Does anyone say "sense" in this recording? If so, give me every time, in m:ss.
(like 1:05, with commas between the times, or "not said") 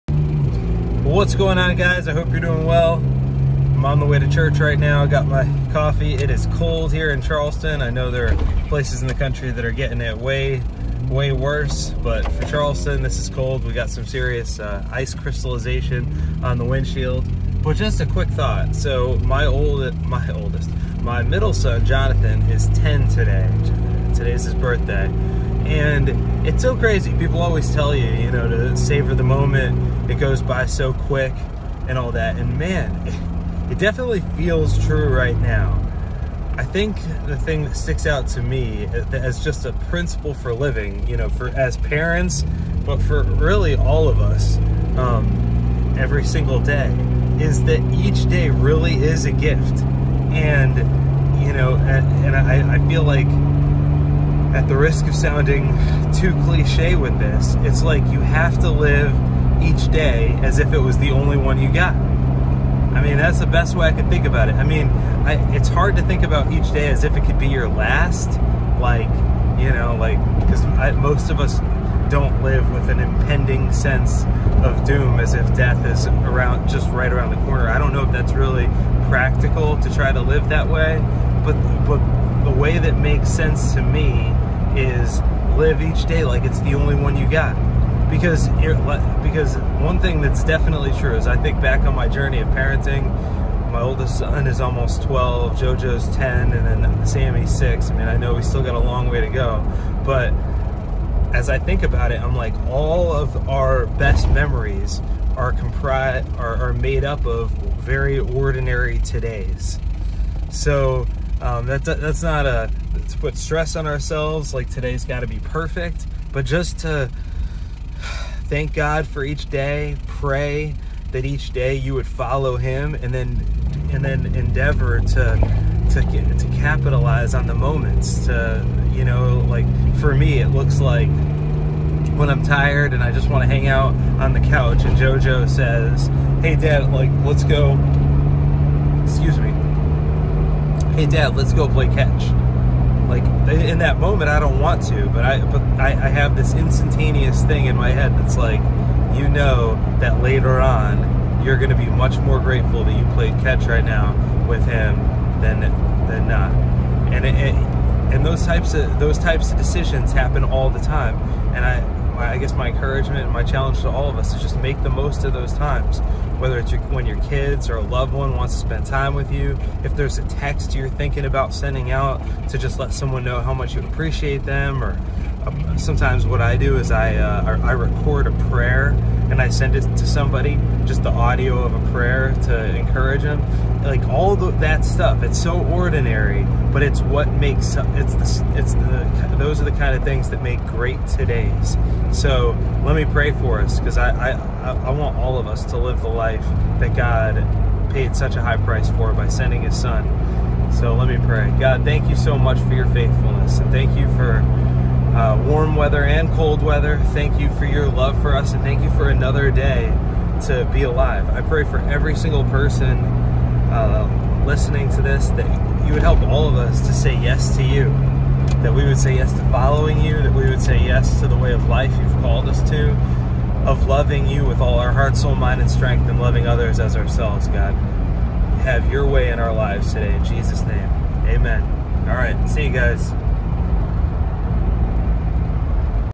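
1:13, 1:23.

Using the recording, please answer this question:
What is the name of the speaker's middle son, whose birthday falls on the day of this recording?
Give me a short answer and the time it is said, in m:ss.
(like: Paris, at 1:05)
Jonathan, at 0:21.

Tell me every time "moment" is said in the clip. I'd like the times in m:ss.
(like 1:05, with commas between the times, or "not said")
0:29, 2:07, 2:23.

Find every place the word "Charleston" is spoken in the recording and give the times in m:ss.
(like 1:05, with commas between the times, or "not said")
0:07, 0:12.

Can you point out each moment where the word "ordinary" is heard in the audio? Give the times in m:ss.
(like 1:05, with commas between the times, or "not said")
1:48, 3:05.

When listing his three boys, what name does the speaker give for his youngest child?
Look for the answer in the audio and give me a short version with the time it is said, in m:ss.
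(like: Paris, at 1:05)
Sammy, at 1:37.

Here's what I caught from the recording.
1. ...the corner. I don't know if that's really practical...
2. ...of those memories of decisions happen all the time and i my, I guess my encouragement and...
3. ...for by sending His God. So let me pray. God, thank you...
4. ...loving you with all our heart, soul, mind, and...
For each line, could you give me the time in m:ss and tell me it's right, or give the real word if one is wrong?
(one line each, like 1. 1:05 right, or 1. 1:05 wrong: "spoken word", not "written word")
1. 1:17 right
2. 2:38 wrong: "types", not "memories"
3. 3:18 wrong: "Son", not "God"
4. 3:43 right.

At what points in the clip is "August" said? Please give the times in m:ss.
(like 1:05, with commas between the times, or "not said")
not said.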